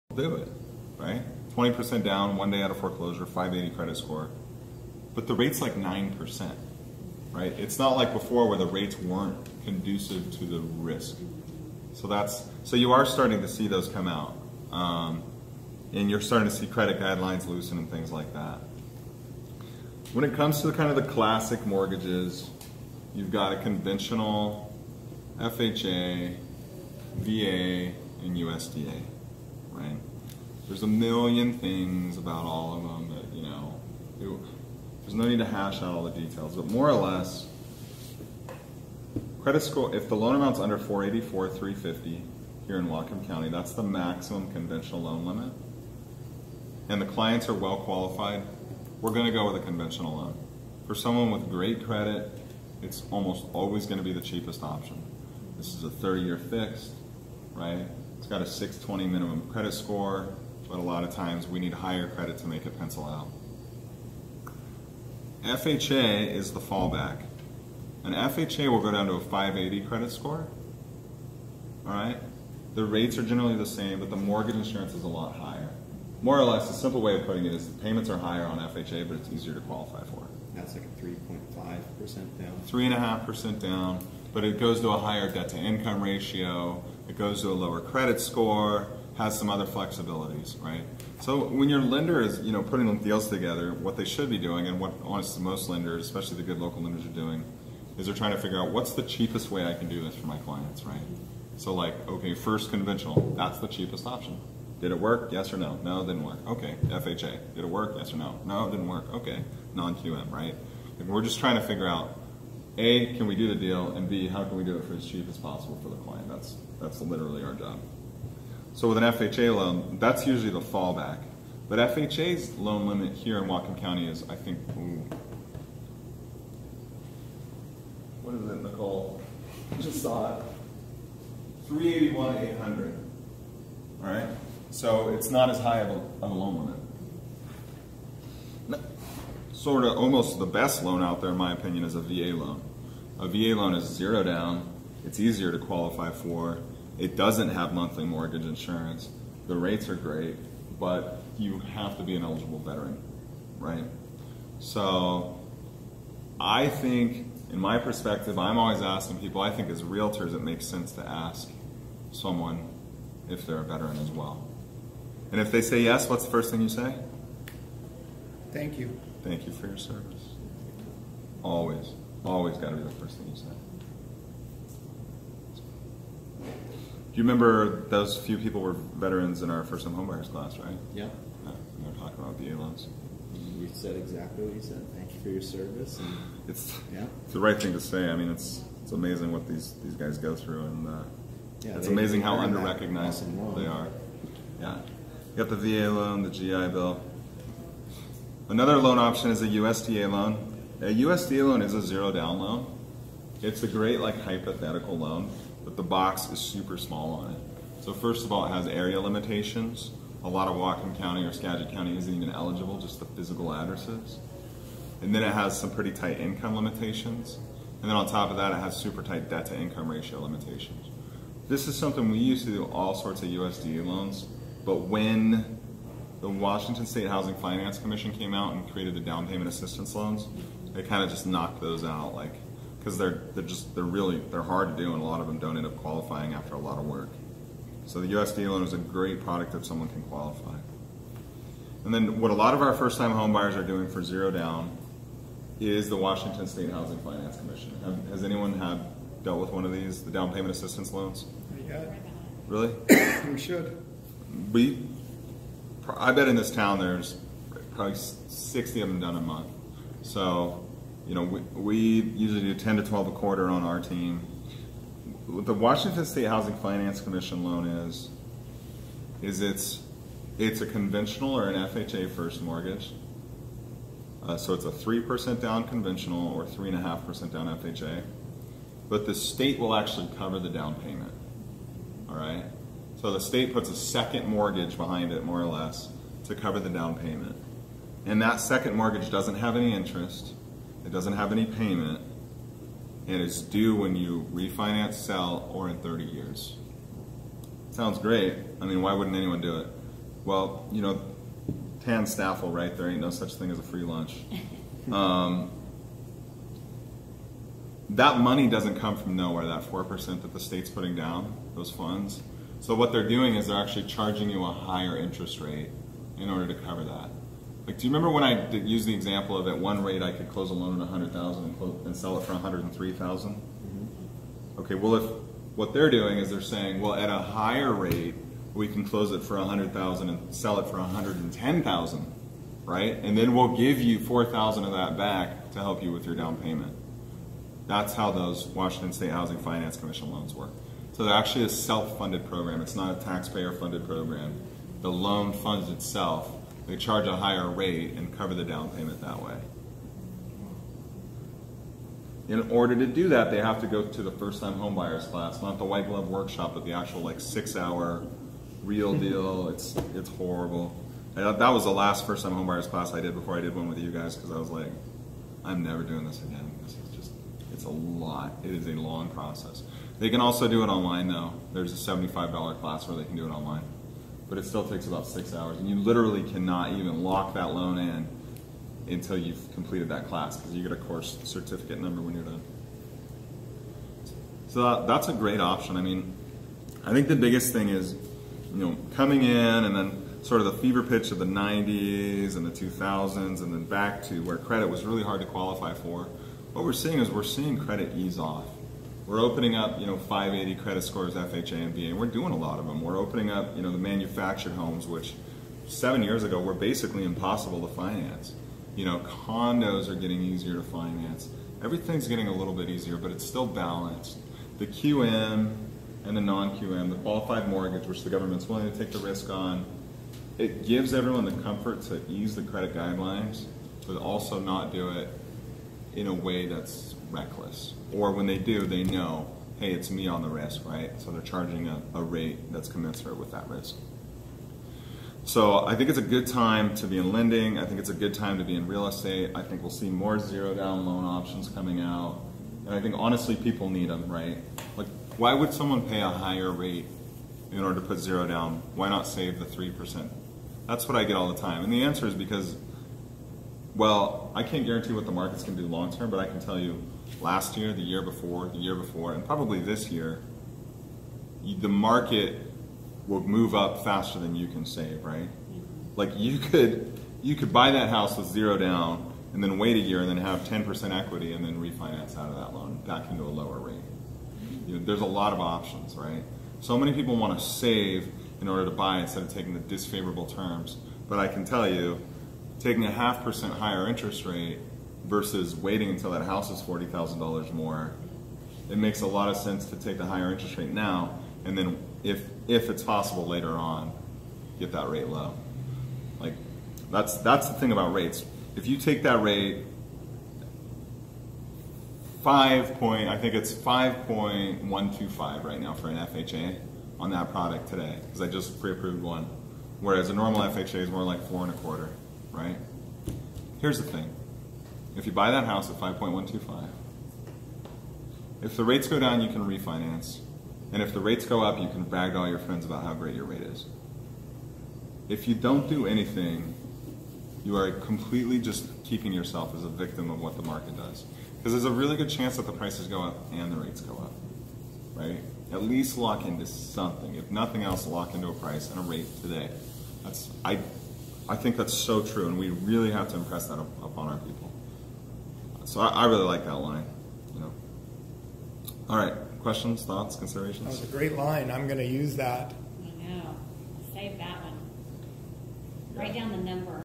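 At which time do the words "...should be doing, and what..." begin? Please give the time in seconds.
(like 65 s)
94 s.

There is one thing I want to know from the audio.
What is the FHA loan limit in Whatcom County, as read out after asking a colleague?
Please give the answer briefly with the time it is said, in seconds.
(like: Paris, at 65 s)
381,800, at 131 s.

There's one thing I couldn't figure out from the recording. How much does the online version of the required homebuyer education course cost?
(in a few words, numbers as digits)
$75.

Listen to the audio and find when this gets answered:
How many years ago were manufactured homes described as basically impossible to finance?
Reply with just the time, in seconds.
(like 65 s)
405 s.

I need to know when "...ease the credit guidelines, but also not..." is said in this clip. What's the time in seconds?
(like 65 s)
422 s.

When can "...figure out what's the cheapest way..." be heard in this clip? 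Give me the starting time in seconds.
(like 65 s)
98 s.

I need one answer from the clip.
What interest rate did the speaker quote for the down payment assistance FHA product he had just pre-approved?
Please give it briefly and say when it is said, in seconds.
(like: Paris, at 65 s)
5.125%, at 503 s.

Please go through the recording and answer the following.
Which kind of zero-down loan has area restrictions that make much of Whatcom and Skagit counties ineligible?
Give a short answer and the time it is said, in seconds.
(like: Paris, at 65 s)
USDA loan, at 199 s.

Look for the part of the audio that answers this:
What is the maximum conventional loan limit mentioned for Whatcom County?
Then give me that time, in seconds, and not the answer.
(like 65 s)
40 s.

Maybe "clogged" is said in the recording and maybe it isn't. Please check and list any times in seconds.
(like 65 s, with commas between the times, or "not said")
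not said.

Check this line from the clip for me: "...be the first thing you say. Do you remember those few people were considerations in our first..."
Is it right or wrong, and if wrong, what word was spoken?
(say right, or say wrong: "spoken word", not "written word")
wrong: "veterans", not "considerations".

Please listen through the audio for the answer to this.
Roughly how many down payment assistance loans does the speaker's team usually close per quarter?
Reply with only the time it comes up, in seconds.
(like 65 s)
262 s.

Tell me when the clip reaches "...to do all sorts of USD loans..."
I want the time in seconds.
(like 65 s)
222 s.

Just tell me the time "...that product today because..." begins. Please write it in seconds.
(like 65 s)
507 s.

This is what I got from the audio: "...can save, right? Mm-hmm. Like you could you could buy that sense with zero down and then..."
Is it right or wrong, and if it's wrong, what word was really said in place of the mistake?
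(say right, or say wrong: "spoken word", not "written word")
wrong: "house", not "sense".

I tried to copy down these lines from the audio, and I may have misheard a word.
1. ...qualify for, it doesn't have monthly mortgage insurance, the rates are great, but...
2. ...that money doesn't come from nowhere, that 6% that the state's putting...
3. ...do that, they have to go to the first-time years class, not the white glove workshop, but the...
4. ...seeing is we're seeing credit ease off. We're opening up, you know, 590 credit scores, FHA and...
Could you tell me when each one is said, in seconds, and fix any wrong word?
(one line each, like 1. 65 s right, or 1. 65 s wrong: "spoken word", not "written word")
1. 145 s right
2. 307 s wrong: "4", not "6"
3. 352 s wrong: "homebuyers", not "years"
4. 396 s wrong: "580", not "590".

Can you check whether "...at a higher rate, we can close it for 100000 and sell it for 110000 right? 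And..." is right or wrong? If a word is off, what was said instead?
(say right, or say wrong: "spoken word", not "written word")
right.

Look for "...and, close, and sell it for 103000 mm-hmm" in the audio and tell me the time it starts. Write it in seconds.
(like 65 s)
321 s.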